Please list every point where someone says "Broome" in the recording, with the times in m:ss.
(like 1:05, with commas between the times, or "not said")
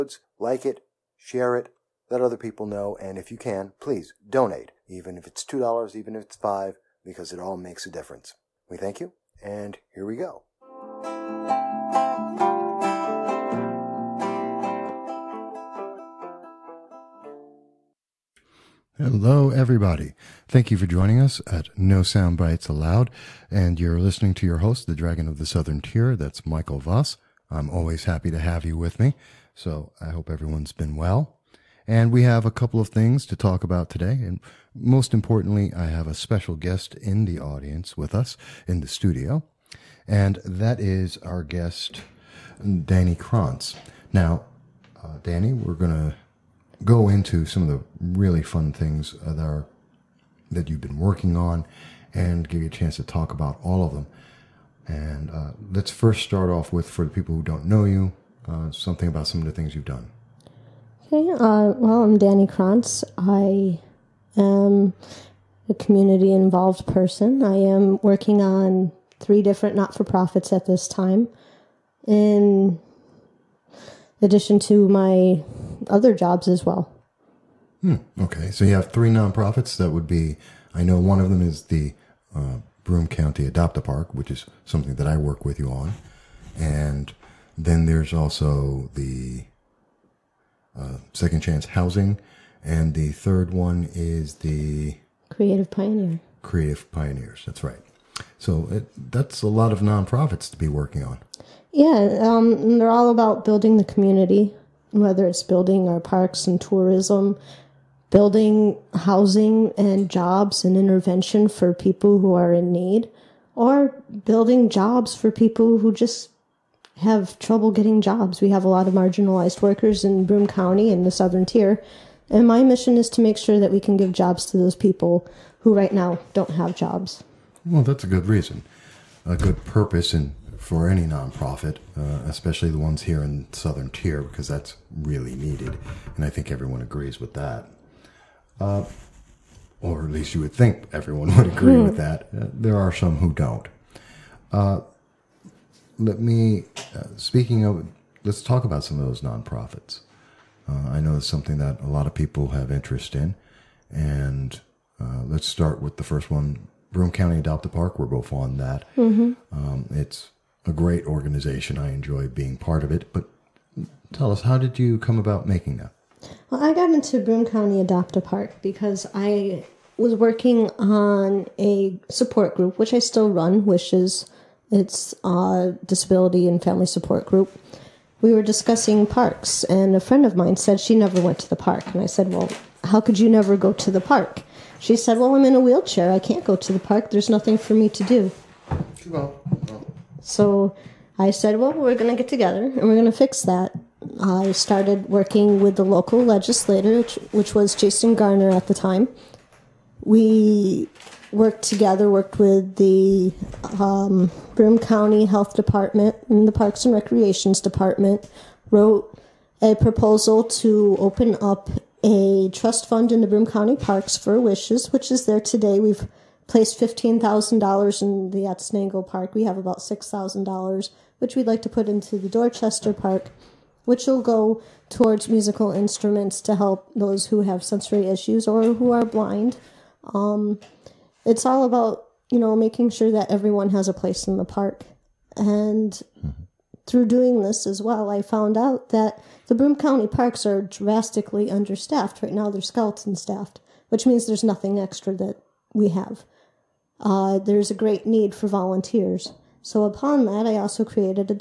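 1:22, 2:00, 2:36, 2:47, 3:24, 3:33, 3:59.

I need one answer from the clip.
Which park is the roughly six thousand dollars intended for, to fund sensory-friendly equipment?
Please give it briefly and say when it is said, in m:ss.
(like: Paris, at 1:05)
Dorchester Park, at 3:42.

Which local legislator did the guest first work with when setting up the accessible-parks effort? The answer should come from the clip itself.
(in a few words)
Jason Garnar.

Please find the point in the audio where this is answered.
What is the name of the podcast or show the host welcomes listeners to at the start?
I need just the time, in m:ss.
0:21.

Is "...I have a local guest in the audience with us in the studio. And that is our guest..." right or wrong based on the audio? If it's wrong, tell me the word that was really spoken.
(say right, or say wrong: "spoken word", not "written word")
wrong: "special", not "local".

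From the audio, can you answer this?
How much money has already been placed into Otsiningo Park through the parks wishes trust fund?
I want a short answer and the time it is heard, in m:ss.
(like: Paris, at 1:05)
$15,000, at 3:36.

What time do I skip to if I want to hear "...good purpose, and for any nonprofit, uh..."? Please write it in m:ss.
2:09.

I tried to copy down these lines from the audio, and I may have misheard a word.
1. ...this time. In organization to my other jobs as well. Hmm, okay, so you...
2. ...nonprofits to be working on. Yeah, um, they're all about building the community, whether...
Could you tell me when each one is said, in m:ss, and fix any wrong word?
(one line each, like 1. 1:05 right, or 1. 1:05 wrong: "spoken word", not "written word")
1. 1:10 wrong: "addition", not "organization"
2. 1:39 right.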